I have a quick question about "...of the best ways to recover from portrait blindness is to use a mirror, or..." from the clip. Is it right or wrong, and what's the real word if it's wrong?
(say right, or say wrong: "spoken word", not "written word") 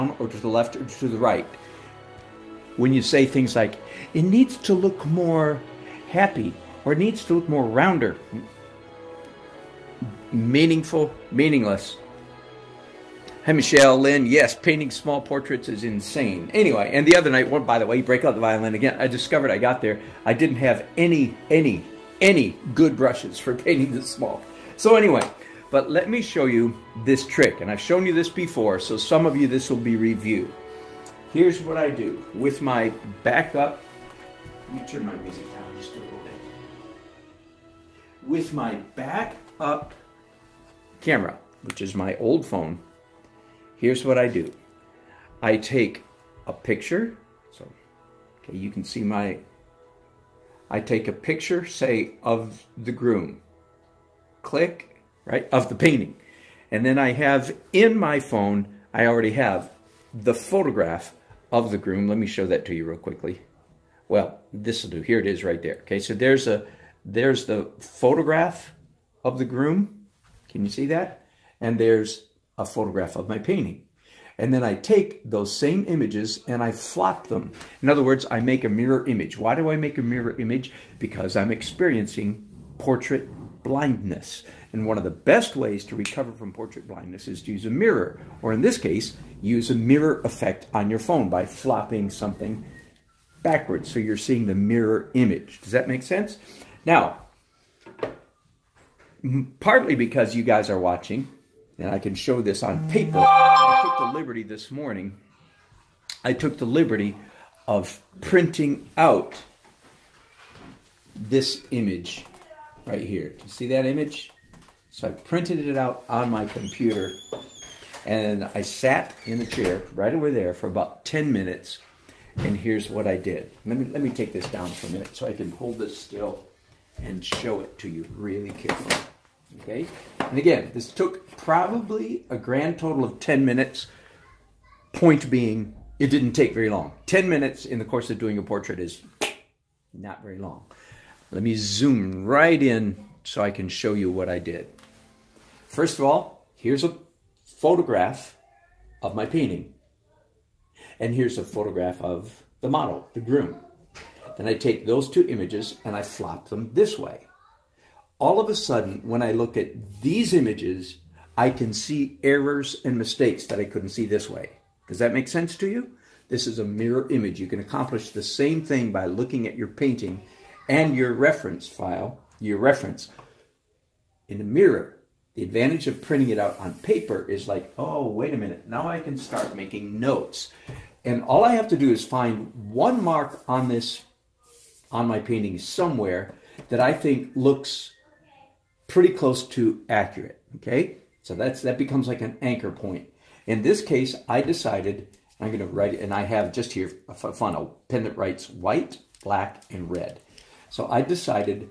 right.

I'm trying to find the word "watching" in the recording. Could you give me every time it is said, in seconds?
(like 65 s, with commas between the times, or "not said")
100 s.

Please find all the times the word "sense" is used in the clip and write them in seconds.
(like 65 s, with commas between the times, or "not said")
96 s, 165 s.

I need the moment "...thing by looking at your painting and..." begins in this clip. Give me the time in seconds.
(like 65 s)
168 s.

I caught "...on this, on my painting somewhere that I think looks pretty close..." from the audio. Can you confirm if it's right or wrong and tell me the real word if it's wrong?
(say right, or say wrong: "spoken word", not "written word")
right.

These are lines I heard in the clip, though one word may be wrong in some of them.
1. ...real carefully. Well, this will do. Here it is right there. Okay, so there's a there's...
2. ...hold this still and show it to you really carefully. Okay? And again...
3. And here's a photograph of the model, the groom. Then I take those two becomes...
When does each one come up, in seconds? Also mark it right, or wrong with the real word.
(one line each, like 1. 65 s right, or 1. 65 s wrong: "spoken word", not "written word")
1. 62 s wrong: "quickly", not "carefully"
2. 125 s right
3. 150 s wrong: "images", not "becomes".